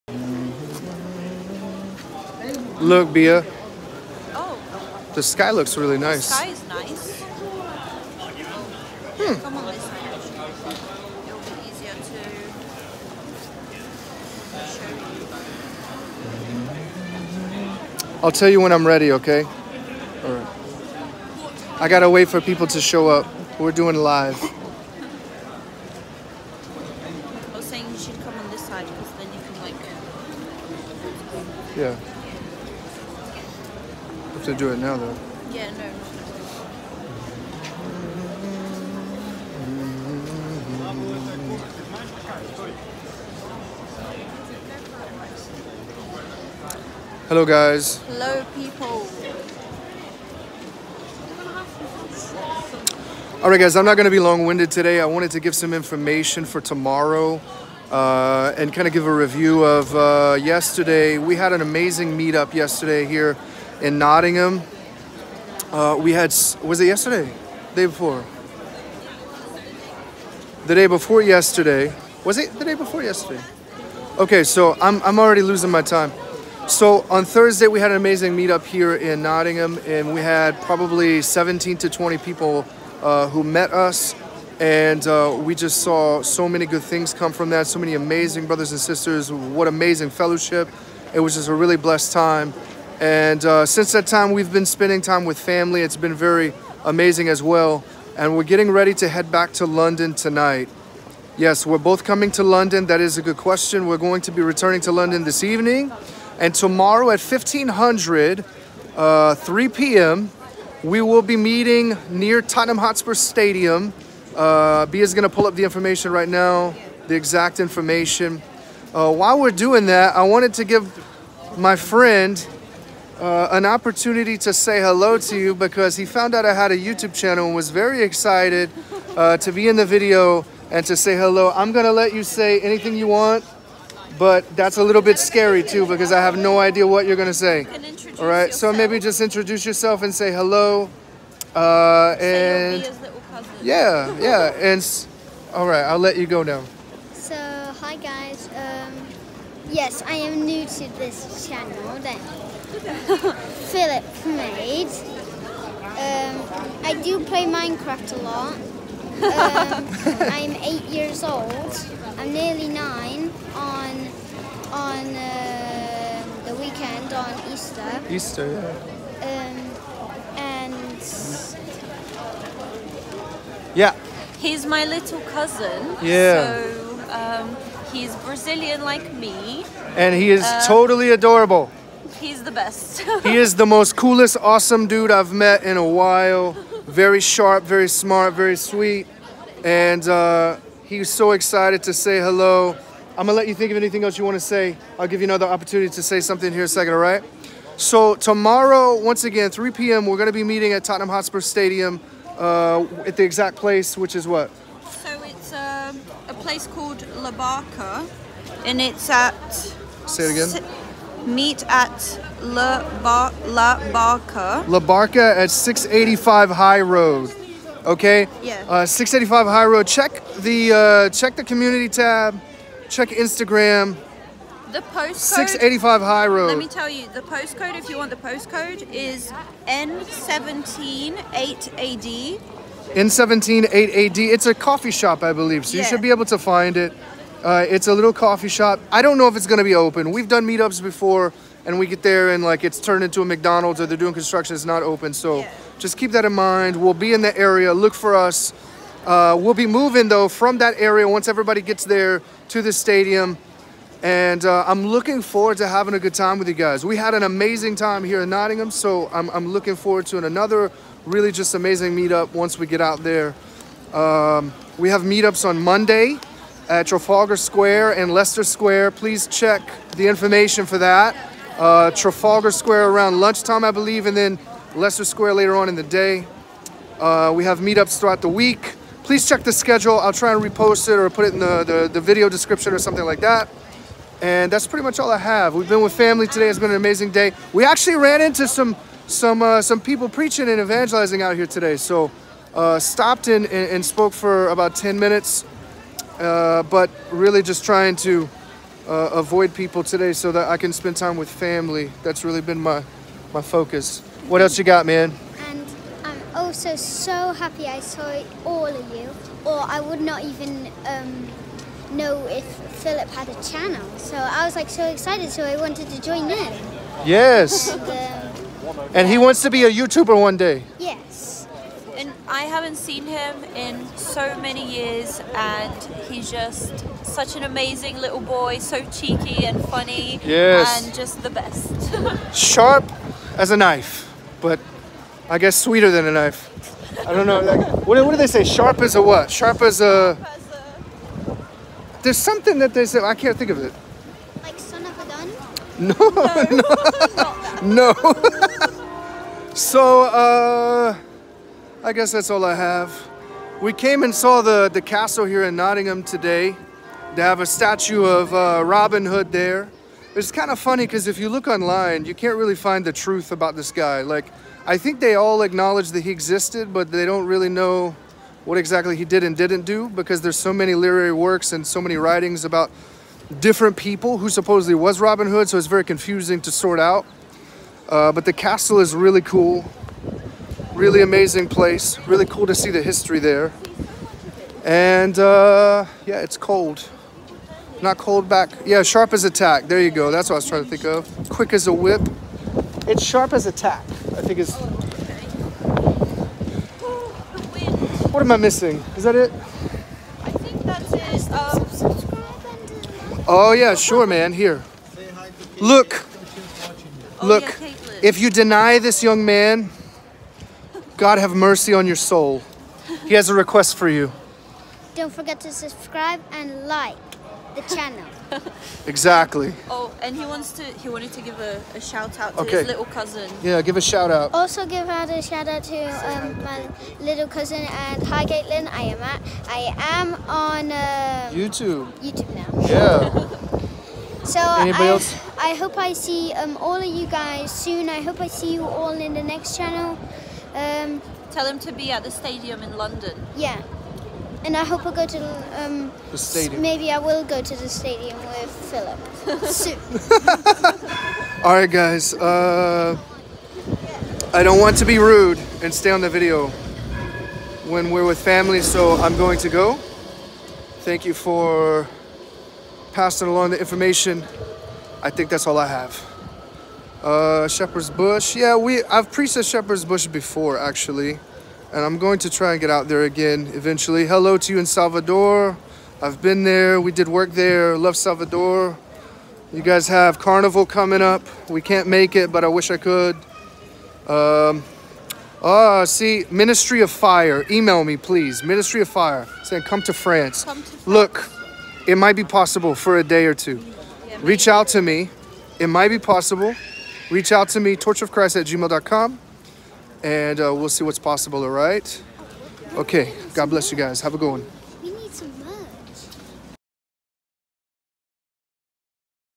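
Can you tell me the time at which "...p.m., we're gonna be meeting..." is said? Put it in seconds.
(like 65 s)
199 s.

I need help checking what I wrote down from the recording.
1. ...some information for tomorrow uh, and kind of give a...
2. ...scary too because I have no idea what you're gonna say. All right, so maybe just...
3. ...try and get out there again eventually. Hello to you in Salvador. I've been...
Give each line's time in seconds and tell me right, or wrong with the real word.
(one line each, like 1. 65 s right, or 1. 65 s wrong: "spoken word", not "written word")
1. 55 s right
2. 135 s right
3. 472 s right.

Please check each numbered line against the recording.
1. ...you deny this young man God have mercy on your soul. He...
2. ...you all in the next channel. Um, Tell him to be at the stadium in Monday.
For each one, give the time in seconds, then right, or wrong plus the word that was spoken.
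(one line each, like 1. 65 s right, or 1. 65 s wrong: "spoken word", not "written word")
1. 408 s right
2. 438 s wrong: "London", not "Monday".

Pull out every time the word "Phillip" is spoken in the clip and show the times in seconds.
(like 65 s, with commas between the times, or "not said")
152 s, 312 s, 448 s.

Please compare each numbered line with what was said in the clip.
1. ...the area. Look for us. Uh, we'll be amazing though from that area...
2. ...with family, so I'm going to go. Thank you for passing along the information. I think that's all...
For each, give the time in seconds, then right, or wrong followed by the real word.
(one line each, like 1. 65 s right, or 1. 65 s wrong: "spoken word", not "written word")
1. 247 s wrong: "moving", not "amazing"
2. 458 s right.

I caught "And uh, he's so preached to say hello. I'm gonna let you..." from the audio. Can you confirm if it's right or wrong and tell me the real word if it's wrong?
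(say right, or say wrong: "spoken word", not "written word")
wrong: "excited", not "preached".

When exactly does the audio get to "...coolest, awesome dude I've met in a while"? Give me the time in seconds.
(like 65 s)
183 s.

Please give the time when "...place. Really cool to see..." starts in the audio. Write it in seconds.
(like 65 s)
381 s.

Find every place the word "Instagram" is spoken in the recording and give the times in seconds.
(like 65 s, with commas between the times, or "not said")
223 s.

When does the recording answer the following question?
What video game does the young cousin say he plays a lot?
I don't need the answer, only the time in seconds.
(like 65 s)
157 s.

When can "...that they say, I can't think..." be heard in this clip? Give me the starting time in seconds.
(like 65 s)
342 s.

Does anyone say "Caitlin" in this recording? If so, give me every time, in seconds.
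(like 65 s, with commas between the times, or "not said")
428 s.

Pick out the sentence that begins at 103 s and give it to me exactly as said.
We're going to be returning to London this evening.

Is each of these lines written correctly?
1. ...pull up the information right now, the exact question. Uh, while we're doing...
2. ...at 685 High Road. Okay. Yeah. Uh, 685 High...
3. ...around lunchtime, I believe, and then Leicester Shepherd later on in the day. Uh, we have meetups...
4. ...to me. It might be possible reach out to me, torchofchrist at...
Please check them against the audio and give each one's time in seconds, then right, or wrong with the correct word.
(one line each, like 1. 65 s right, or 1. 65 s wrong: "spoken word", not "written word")
1. 115 s wrong: "information", not "question"
2. 215 s right
3. 272 s wrong: "Square", not "Shepherd"
4. 494 s right.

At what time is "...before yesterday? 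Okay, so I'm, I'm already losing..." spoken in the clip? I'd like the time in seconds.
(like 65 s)
72 s.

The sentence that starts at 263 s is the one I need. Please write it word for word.
Um, we have meetups on Monday at Trafalgar Square and Leicester Square.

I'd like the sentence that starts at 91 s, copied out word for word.
It was just a really blessed time.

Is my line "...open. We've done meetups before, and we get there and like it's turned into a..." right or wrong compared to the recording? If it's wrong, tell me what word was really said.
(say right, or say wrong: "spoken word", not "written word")
right.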